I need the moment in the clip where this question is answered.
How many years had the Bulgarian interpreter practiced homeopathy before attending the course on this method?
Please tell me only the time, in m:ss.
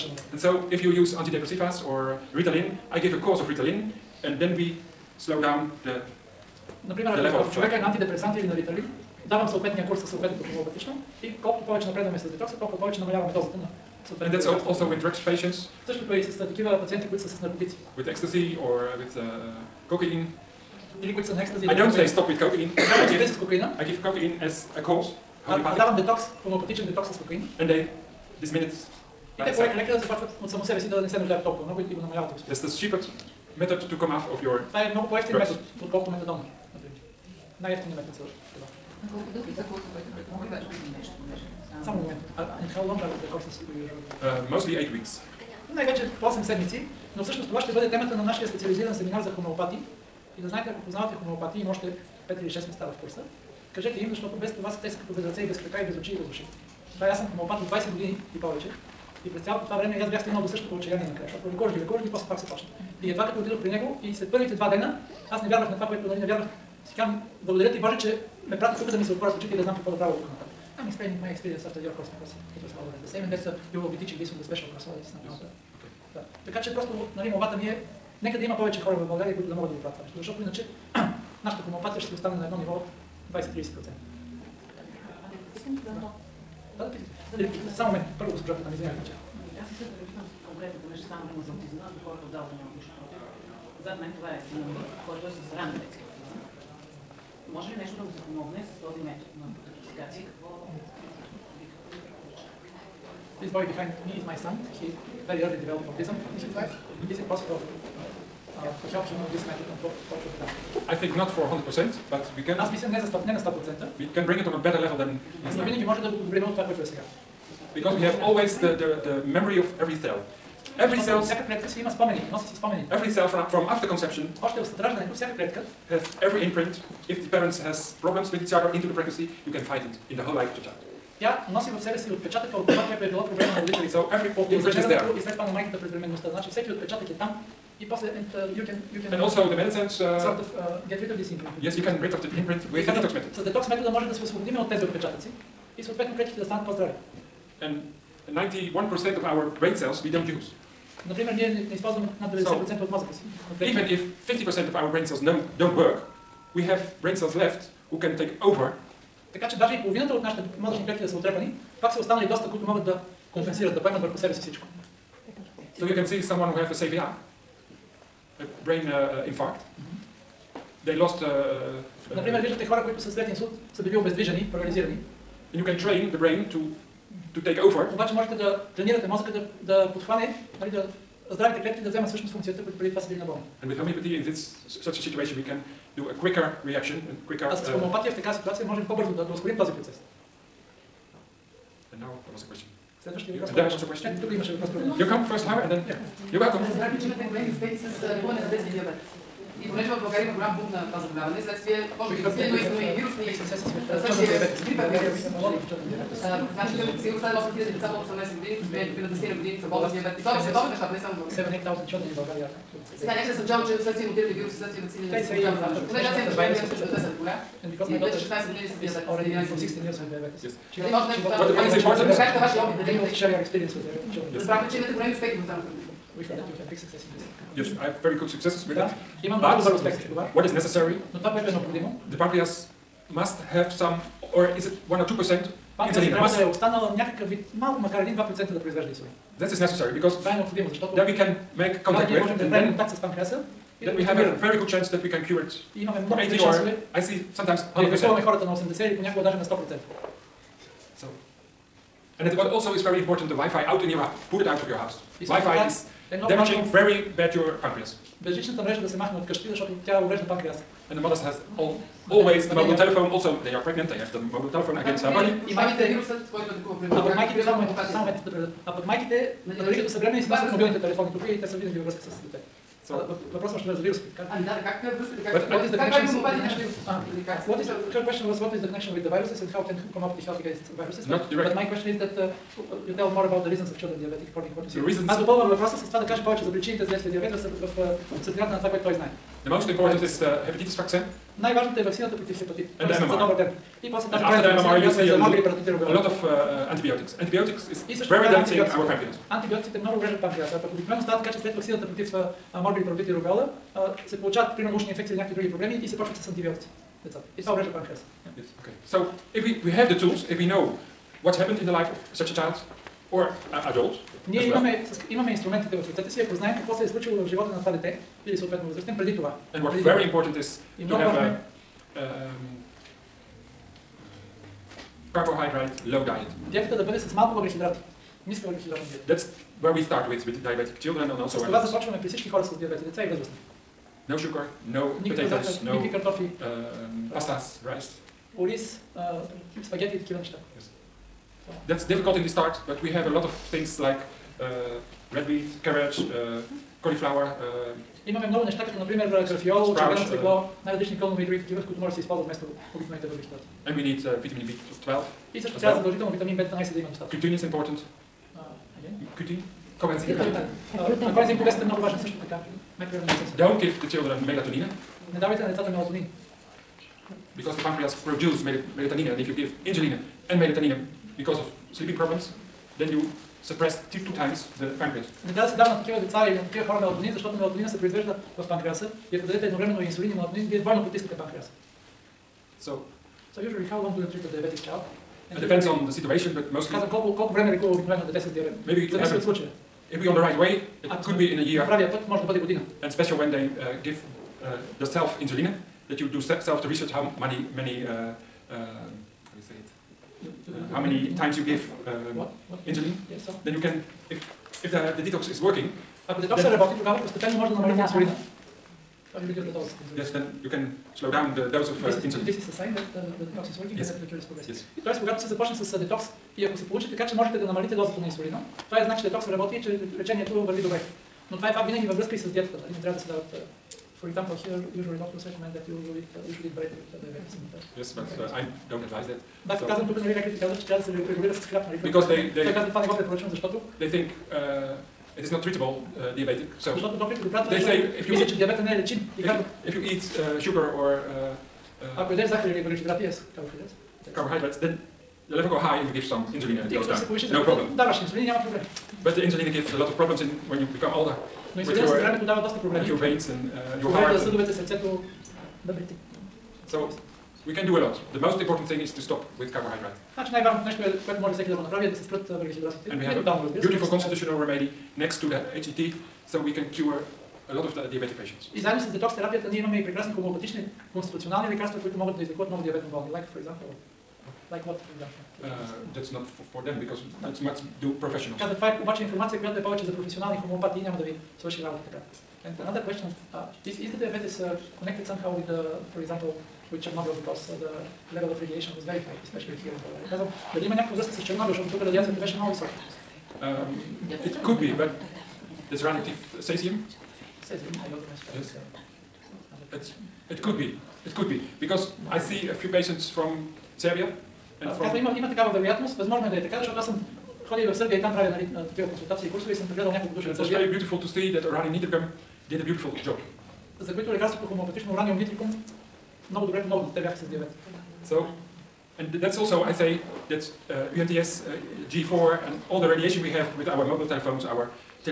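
0:57.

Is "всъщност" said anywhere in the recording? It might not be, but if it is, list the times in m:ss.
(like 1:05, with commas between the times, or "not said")
0:47, 3:02.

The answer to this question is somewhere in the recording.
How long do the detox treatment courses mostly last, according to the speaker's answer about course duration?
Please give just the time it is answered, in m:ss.
0:44.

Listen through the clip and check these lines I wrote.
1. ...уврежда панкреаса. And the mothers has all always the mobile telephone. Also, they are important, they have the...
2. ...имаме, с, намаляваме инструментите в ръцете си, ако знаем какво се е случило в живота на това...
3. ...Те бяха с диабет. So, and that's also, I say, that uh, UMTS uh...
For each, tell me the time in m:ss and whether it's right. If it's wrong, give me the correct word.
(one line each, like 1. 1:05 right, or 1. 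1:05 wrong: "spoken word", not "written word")
1. 4:20 wrong: "pregnant", not "important"
2. 5:14 wrong: "имаме", not "намаляваме"
3. 8:36 right.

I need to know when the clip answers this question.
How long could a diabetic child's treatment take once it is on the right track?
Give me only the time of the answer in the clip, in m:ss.
6:31.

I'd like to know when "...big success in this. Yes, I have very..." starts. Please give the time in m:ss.
3:46.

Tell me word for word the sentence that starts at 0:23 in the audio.
I give cocaine as a cause.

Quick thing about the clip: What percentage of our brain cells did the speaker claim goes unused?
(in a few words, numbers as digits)
91%.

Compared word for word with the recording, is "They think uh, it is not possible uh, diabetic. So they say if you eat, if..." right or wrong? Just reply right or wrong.
wrong.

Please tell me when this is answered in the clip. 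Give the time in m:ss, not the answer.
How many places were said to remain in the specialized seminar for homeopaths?
0:52.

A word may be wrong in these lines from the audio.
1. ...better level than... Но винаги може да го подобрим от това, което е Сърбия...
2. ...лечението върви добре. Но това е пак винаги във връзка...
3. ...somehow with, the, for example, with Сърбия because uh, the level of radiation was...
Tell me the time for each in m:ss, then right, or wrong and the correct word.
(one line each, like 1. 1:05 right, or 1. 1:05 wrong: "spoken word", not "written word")
1. 1:54 wrong: "Because", not "Сърбия"
2. 6:59 right
3. 8:05 wrong: "Chernobyl", not "Сърбия".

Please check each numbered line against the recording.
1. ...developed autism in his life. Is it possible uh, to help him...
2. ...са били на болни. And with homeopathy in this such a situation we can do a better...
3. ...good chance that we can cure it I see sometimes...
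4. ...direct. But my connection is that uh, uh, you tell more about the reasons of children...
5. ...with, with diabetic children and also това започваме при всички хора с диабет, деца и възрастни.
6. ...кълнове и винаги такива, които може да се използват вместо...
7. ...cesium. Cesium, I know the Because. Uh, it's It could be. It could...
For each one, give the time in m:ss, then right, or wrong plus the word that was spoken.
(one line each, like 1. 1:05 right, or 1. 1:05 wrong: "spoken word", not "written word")
1. 1:45 right
2. 3:02 wrong: "quicker", not "better"
3. 4:04 right
4. 4:41 wrong: "question", not "connection"
5. 5:30 right
6. 5:50 wrong: "други", not "винаги"
7. 8:16 wrong: "Yes", not "Because".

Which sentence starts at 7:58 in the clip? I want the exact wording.
Казва, това е обаче информация, която е повече за професионални хомеопати и няма да ви свърши работа така.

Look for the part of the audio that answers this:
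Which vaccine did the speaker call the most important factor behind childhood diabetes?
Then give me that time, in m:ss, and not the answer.
4:50.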